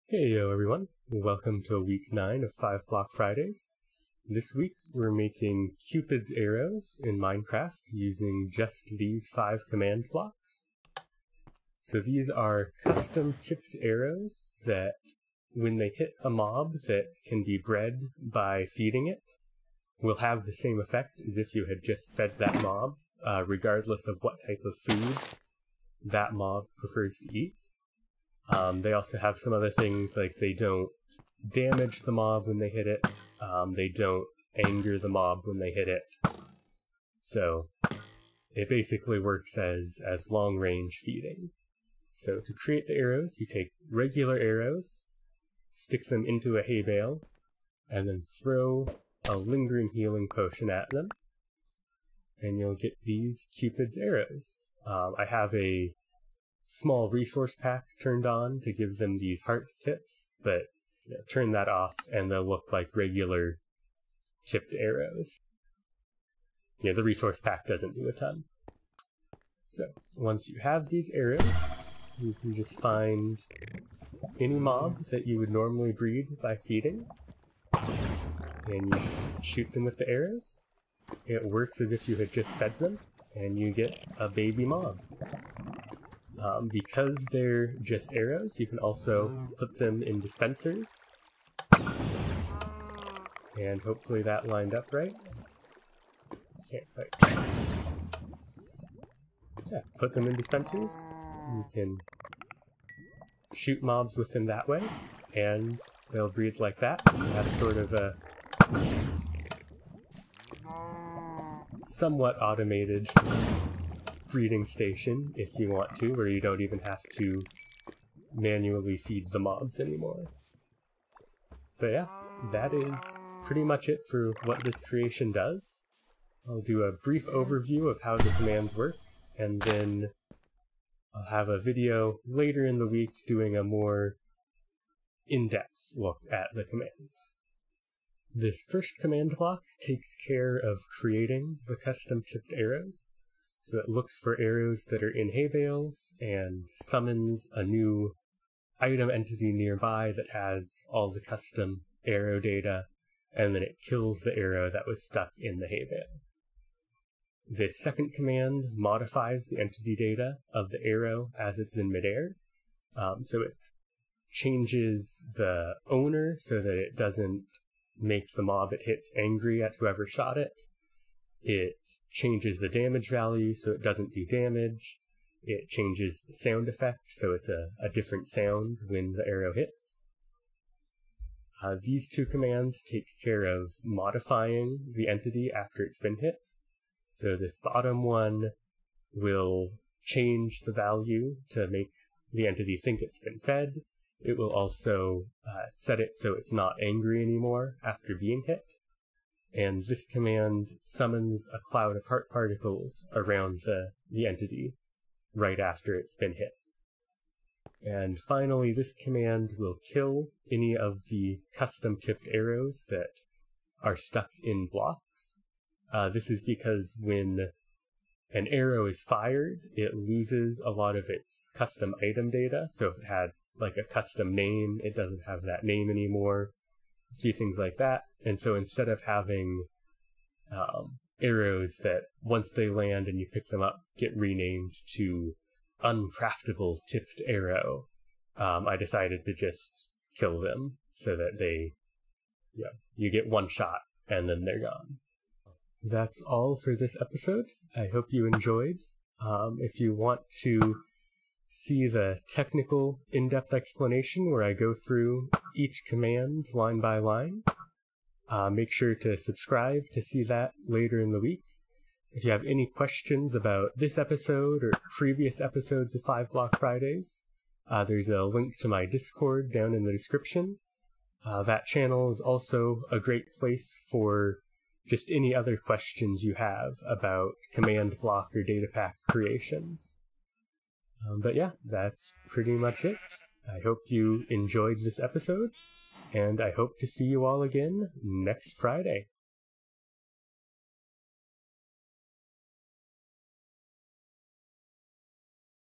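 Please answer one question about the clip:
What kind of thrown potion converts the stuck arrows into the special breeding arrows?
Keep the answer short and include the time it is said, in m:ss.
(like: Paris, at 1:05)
lingering healing potion, at 0:49.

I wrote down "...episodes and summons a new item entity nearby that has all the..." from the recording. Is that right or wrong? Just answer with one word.
wrong.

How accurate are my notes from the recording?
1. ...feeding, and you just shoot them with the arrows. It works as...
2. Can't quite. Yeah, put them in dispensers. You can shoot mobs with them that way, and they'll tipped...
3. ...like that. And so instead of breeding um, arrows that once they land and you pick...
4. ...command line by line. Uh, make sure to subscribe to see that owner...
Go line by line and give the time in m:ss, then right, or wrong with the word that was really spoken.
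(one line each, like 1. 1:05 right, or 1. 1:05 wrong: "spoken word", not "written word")
1. 1:16 right
2. 1:36 wrong: "breed", not "tipped"
3. 3:47 wrong: "having", not "breeding"
4. 4:15 wrong: "later", not "owner".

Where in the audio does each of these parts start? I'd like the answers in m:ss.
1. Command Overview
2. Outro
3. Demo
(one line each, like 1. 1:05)
1. 2:22
2. 4:10
3. 1:15.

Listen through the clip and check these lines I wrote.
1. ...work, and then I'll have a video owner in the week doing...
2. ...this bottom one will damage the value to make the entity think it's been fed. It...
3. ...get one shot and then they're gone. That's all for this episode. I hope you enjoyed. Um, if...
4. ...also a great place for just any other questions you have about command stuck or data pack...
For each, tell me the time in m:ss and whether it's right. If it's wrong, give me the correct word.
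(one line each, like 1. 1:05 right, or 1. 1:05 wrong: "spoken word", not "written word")
1. 2:08 wrong: "later", not "owner"
2. 3:07 wrong: "change", not "damage"
3. 4:03 right
4. 4:32 wrong: "block", not "stuck".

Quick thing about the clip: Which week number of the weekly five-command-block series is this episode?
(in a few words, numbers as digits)
9.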